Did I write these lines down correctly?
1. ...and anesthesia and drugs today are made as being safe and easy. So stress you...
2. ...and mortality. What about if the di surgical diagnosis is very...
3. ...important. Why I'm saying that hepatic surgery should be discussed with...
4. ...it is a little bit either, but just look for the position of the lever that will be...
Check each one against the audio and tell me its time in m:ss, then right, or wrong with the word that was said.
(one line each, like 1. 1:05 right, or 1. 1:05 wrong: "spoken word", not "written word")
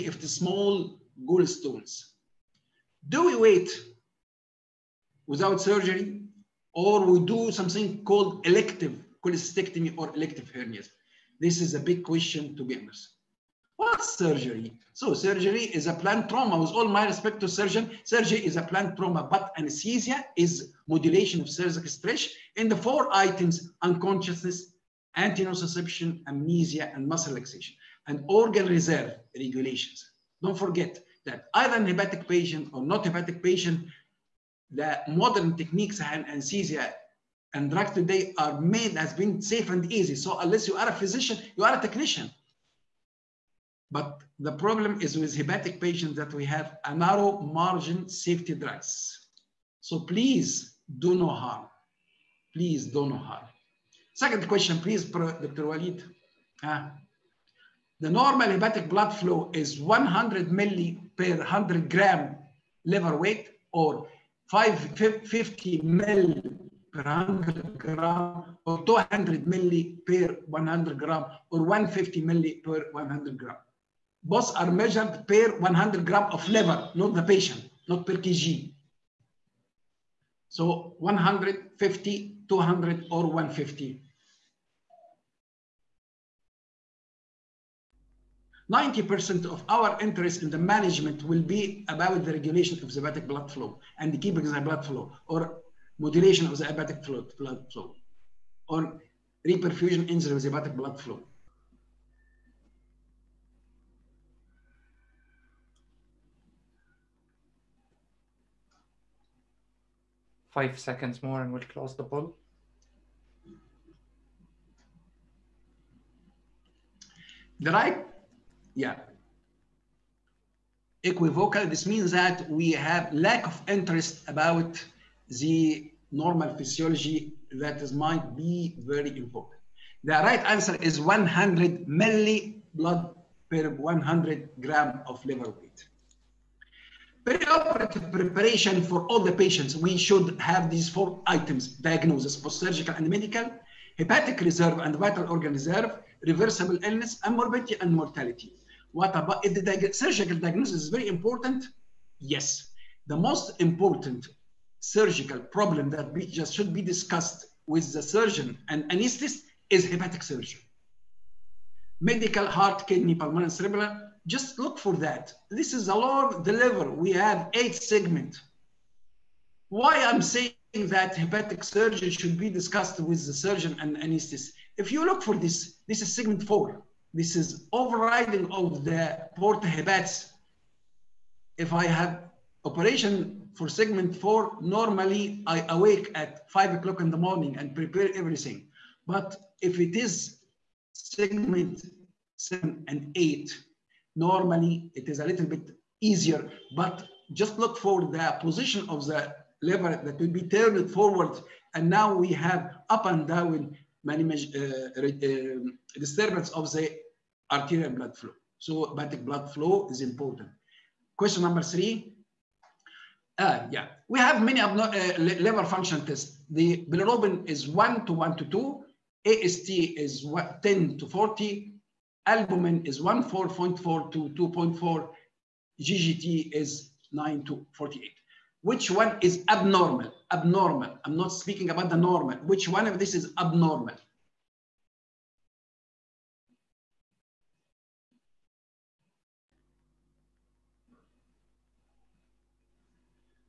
1. 0:36 wrong: "unless", not "stress"
2. 2:27 right
3. 2:47 wrong: "segment", not "important"
4. 3:14 wrong: "easier", not "either".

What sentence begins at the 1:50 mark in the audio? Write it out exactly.
five seconds more and we'll close the poll.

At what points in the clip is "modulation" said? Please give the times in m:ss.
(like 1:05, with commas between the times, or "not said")
0:20, 1:36.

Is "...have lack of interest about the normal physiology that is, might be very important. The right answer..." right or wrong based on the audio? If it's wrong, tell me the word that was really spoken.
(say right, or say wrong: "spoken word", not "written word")
right.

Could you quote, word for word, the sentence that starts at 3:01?
If I have operation for segment four, normally I awake at five o'clock in the morning and prepare everything.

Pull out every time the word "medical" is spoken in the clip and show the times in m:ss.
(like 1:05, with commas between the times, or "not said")
2:23, 2:42.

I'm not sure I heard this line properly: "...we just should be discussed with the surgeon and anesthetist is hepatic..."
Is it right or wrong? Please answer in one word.
right.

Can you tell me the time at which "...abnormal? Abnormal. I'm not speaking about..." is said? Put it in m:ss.
3:49.